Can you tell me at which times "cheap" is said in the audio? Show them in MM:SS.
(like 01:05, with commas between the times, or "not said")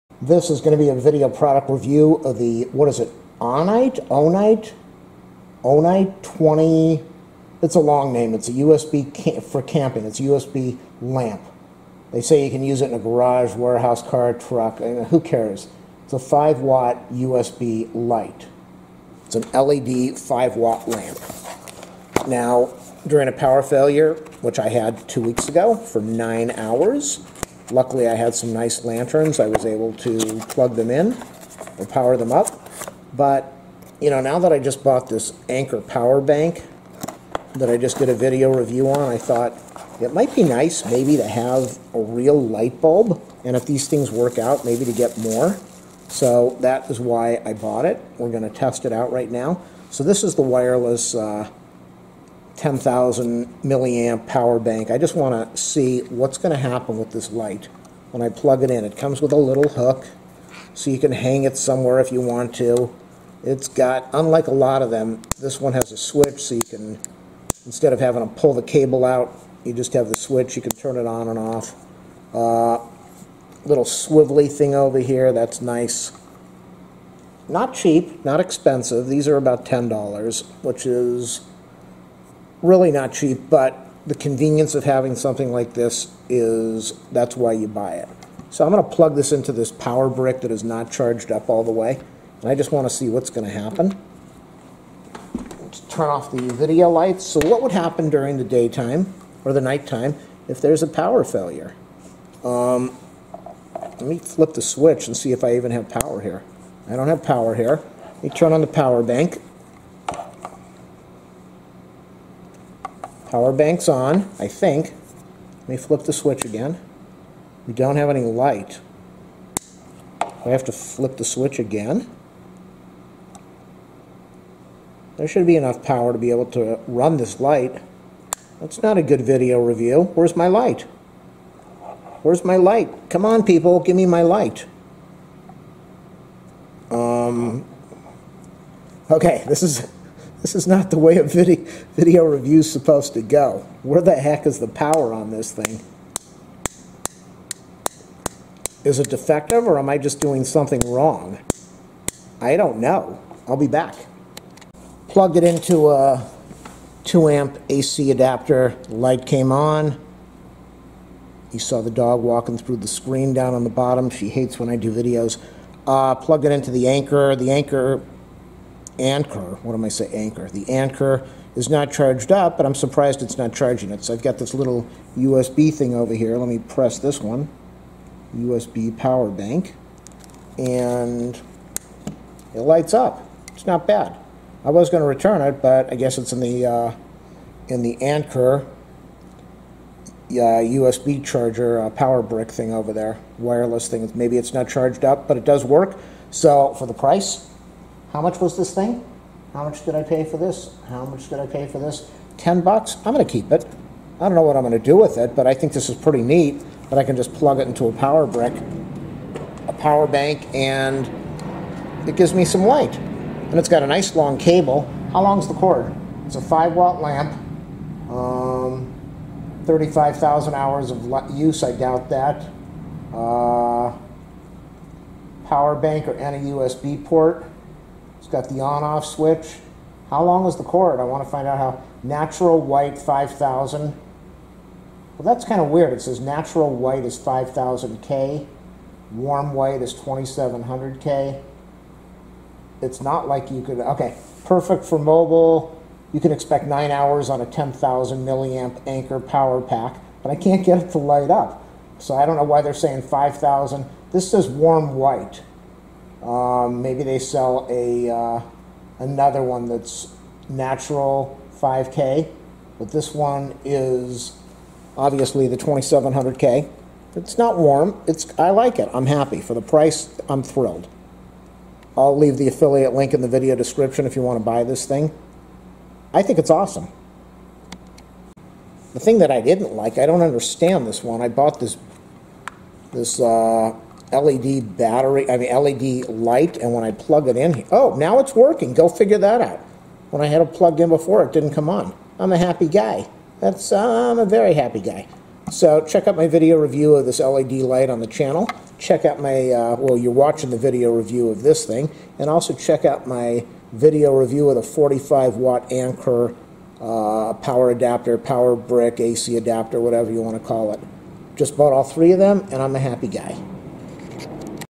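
01:17, 01:23.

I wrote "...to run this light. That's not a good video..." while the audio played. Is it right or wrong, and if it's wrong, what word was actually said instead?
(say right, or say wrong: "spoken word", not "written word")
right.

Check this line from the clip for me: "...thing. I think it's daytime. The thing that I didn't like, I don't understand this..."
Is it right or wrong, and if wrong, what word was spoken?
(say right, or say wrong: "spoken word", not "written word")
wrong: "awesome", not "daytime".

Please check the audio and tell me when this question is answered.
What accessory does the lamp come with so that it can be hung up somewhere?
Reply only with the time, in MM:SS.
00:59.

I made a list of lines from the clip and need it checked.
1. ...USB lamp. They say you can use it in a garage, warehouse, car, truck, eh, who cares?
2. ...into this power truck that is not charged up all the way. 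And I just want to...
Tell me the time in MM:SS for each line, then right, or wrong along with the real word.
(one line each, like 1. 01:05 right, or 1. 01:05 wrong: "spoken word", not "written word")
1. 00:10 right
2. 01:29 wrong: "brick", not "truck".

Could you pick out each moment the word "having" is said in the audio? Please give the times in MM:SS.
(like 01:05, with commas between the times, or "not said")
01:07, 01:24.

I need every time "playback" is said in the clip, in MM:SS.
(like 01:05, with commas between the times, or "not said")
not said.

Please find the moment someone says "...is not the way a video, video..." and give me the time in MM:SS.
02:20.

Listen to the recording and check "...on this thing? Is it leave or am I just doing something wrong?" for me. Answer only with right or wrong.
wrong.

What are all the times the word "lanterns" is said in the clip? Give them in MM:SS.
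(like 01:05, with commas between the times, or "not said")
00:28.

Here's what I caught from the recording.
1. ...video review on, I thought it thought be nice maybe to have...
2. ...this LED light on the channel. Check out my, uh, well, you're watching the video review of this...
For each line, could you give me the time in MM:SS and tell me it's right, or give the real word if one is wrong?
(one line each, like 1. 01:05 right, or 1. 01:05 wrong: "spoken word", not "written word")
1. 00:38 wrong: "might", not "thought"
2. 04:57 right.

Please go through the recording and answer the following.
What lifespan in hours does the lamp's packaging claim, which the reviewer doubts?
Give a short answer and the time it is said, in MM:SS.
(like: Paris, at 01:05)
35,000 hours, at 03:39.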